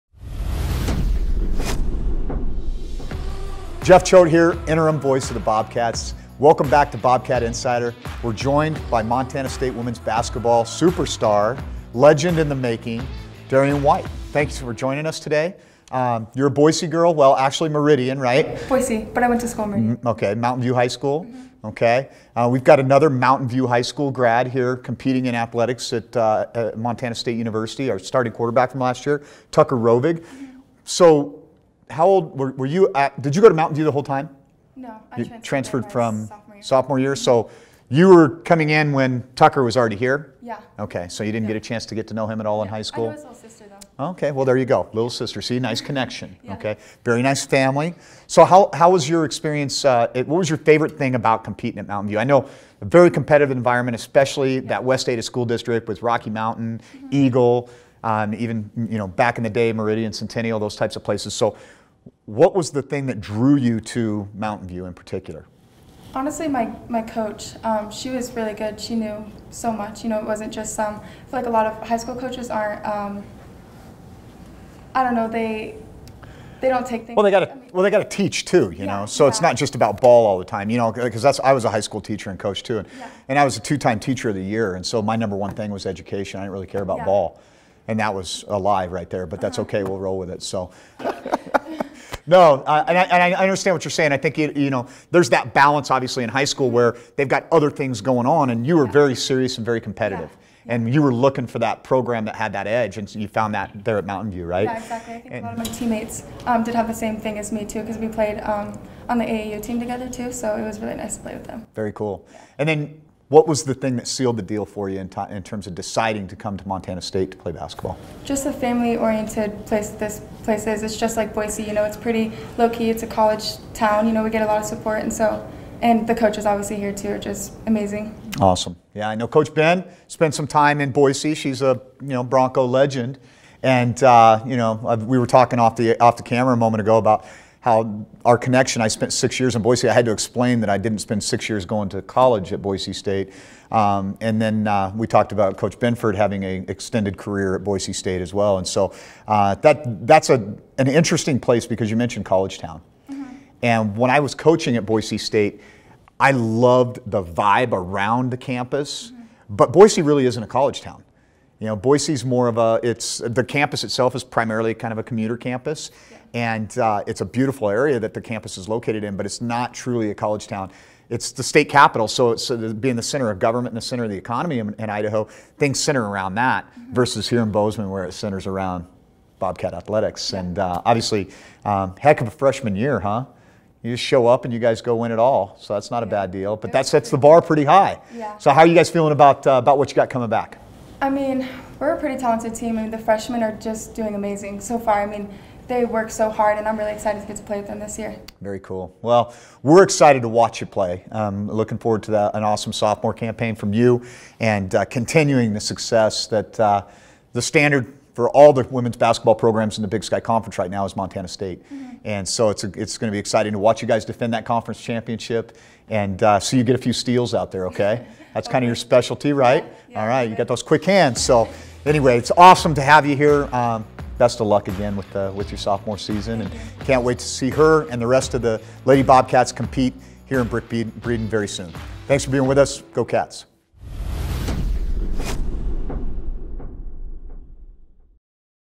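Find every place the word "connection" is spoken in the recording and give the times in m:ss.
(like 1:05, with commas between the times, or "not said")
0:45, 2:18.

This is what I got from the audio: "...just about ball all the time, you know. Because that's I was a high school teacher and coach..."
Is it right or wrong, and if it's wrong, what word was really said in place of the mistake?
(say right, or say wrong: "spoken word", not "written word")
right.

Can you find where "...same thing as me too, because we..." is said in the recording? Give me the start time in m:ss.
1:46.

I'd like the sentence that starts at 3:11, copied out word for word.
I mean, we're a pretty talented team, and the freshmen are just doing amazing so far.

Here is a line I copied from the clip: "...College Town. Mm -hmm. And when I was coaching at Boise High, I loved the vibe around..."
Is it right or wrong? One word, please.
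wrong.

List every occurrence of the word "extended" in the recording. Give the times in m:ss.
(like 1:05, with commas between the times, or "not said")
2:26.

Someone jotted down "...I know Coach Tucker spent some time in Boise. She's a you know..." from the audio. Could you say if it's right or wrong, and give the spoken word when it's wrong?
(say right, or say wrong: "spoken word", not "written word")
wrong: "Ben", not "Tucker".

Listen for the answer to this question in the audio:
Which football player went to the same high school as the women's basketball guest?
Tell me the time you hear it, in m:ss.
0:29.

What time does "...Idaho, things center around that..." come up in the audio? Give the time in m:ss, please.
2:54.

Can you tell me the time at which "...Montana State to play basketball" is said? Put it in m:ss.
1:56.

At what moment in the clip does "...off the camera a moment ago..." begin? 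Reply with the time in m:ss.
2:16.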